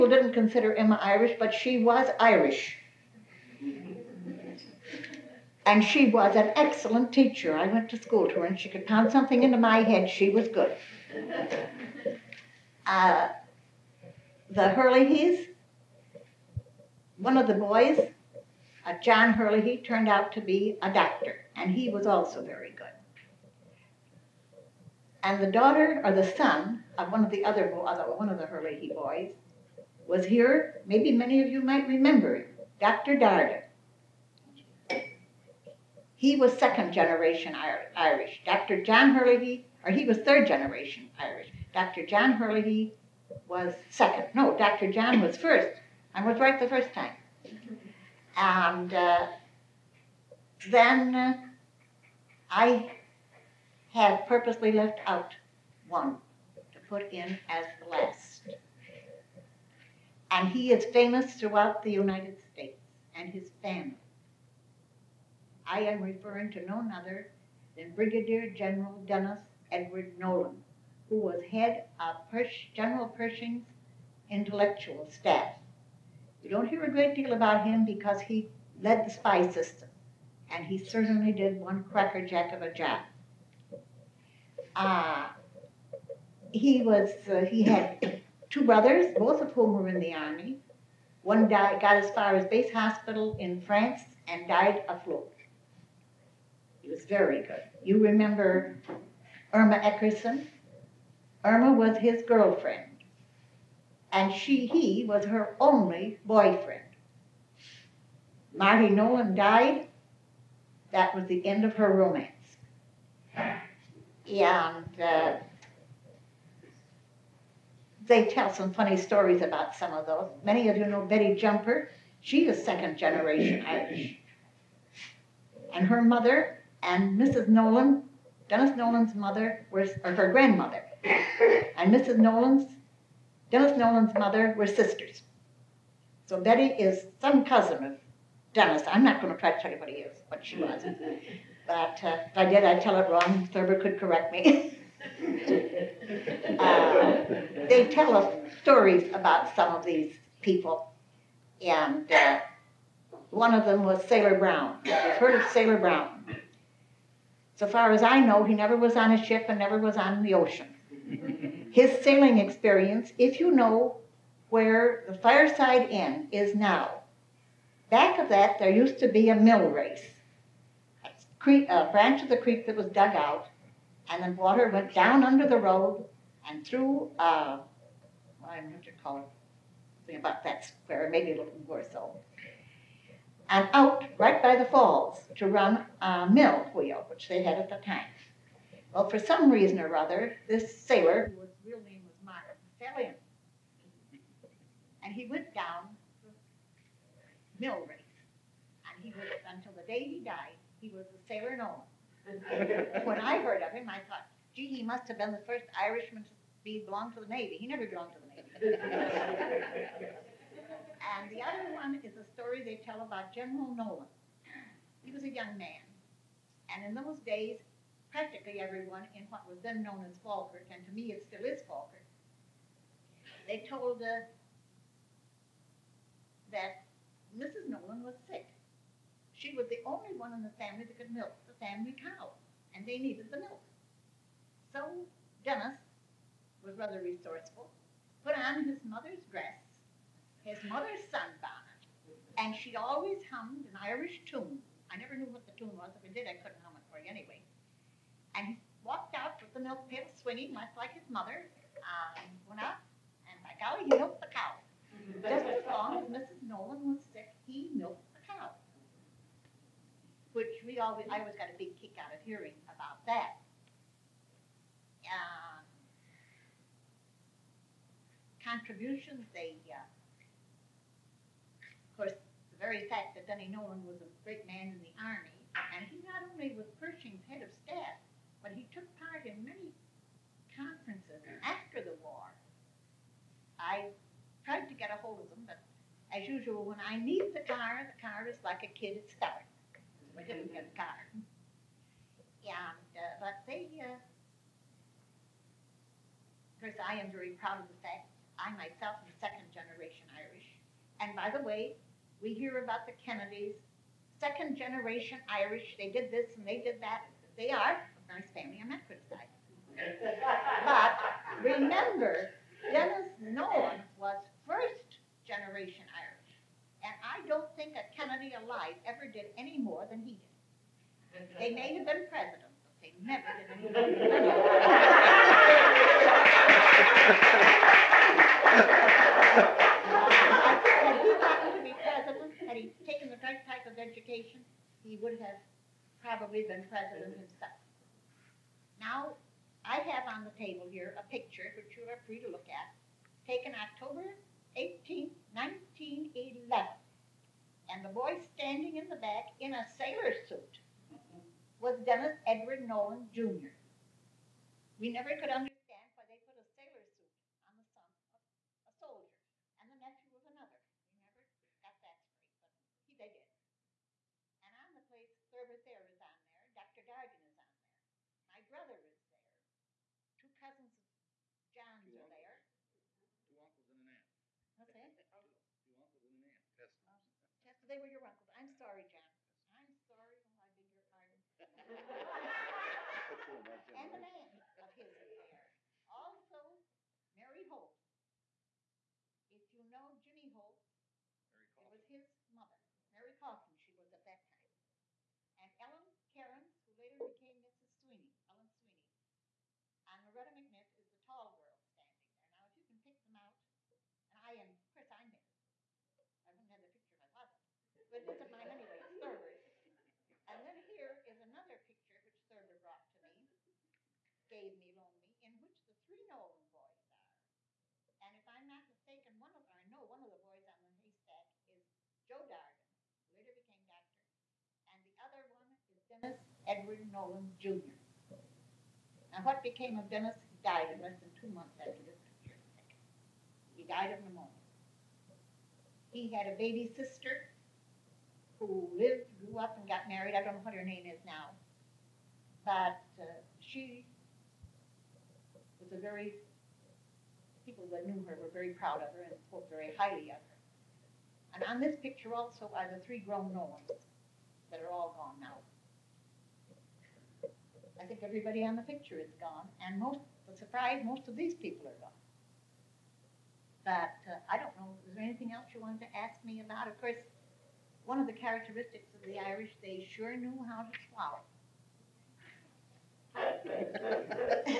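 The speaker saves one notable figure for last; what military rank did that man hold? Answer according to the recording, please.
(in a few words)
Brigadier General.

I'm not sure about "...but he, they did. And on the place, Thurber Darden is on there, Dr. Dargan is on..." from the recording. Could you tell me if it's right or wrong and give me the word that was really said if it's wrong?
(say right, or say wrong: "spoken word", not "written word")
wrong: "Thayer", not "Darden".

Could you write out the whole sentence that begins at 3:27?
He never belonged to the Navy.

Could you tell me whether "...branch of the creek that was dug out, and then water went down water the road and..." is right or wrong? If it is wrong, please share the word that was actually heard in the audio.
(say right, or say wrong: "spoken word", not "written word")
wrong: "under", not "water".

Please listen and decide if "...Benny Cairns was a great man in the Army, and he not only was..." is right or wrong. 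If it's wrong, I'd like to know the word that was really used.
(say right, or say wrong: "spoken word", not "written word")
wrong: "Nolan", not "Cairns".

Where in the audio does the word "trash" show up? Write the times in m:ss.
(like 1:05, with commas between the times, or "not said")
not said.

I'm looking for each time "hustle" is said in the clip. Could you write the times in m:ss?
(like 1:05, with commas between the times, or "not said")
not said.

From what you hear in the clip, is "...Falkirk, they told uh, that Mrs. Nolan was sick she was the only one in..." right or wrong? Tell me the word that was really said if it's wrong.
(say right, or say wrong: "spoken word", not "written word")
right.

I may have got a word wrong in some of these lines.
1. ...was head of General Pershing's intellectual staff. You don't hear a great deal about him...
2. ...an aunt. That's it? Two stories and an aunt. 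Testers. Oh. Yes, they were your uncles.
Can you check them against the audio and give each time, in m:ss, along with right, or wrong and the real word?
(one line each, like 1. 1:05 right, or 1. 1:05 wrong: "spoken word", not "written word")
1. 1:11 right
2. 6:13 wrong: "uncles", not "stories".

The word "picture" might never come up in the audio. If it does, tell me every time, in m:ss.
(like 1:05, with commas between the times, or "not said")
5:41, 6:46, 6:51, 7:12, 7:31, 7:38.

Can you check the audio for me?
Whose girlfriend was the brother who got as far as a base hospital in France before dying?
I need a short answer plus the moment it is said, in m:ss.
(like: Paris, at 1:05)
Irma Eckerson, at 1:39.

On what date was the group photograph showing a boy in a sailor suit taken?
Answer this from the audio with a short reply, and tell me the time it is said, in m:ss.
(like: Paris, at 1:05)
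October 18, 1911, at 5:43.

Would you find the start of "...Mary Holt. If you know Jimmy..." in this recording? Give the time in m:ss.
6:27.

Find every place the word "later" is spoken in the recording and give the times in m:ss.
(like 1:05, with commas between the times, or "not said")
6:36, 7:03.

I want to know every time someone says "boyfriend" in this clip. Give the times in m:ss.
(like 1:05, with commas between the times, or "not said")
1:46.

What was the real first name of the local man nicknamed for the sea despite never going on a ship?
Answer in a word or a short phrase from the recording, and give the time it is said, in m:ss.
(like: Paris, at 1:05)
Martin, at 3:12.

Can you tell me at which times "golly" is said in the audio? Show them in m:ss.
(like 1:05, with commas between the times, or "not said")
4:13.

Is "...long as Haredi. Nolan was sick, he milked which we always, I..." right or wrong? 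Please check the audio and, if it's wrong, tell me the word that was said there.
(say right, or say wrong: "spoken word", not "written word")
wrong: "Mrs", not "Haredi".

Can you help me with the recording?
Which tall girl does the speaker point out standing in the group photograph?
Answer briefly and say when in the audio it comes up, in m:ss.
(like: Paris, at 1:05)
Loretta McNiff, at 6:40.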